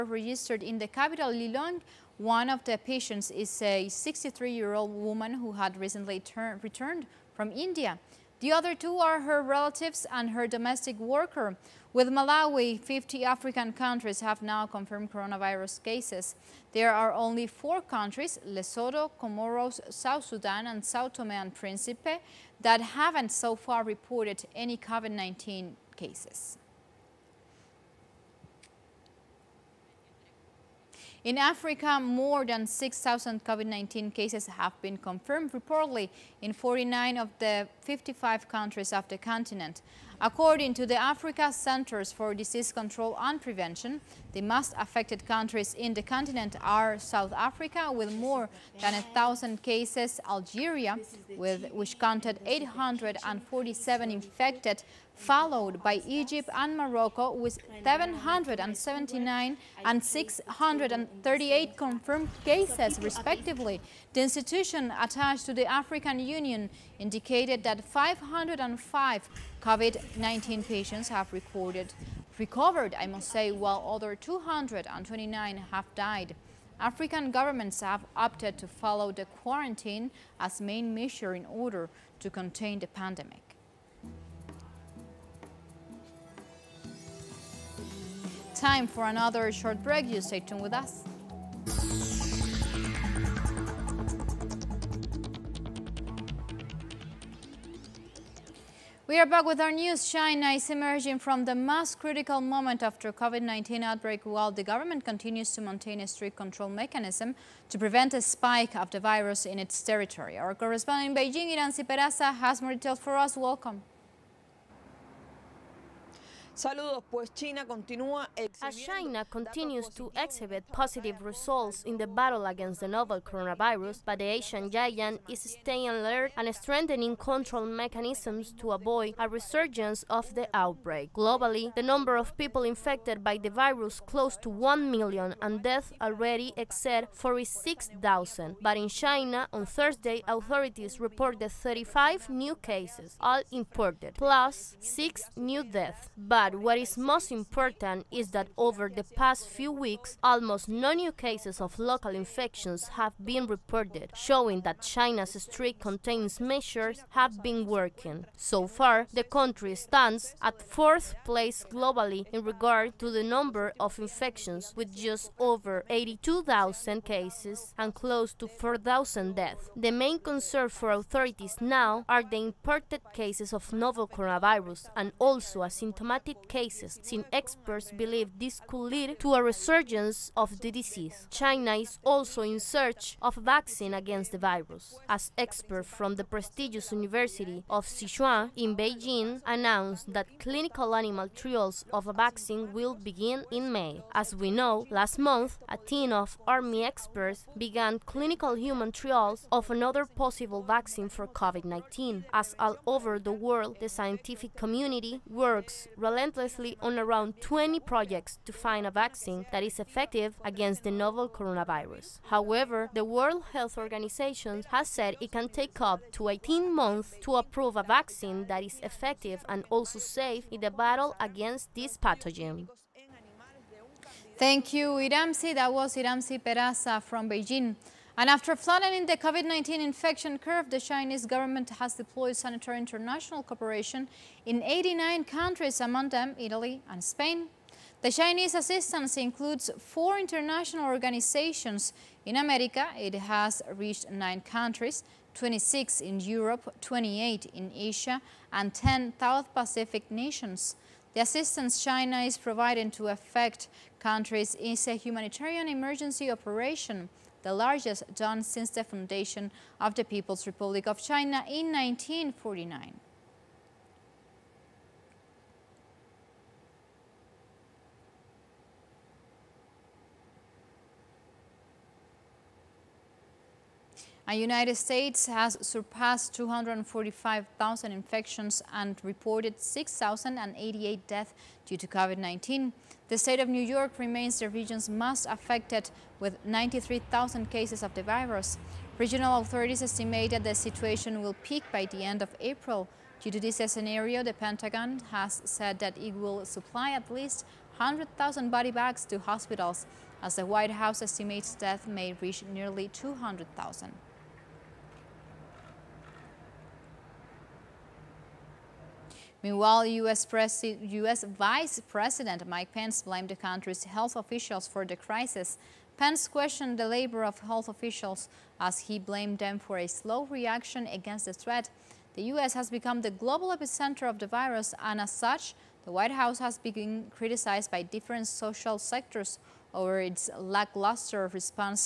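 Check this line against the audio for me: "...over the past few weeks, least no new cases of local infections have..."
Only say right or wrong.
wrong.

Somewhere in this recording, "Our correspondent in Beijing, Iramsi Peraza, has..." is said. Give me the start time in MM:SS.
01:50.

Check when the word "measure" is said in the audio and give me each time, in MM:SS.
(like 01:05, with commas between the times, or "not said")
01:20, 02:36.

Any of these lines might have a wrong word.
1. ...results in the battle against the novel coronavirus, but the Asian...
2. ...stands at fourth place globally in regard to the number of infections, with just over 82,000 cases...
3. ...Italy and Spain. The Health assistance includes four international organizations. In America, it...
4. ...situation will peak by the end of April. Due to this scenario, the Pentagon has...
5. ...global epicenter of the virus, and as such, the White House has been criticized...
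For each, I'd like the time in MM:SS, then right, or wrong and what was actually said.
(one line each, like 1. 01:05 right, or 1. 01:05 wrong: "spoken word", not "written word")
1. 02:01 right
2. 02:39 right
3. 03:56 wrong: "Chinese", not "Health"
4. 04:50 right
5. 05:23 right.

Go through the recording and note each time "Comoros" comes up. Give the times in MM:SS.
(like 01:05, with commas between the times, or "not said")
00:19.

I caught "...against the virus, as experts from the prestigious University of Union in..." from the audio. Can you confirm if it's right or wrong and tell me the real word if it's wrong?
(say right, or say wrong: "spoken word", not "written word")
wrong: "Sichuan", not "Union".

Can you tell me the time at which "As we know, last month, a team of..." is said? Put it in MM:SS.
03:14.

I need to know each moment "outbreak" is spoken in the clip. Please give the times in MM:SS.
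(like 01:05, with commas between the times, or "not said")
01:43, 02:10.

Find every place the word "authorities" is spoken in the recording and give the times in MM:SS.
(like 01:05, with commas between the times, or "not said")
02:20, 02:50, 04:49.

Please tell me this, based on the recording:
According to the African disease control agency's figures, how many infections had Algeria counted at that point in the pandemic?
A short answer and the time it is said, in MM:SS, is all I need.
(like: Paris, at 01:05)
847, at 00:52.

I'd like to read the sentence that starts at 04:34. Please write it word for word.
And United States has surpassed 245,000 infections and reported 6,088 deaths due to COVID-19.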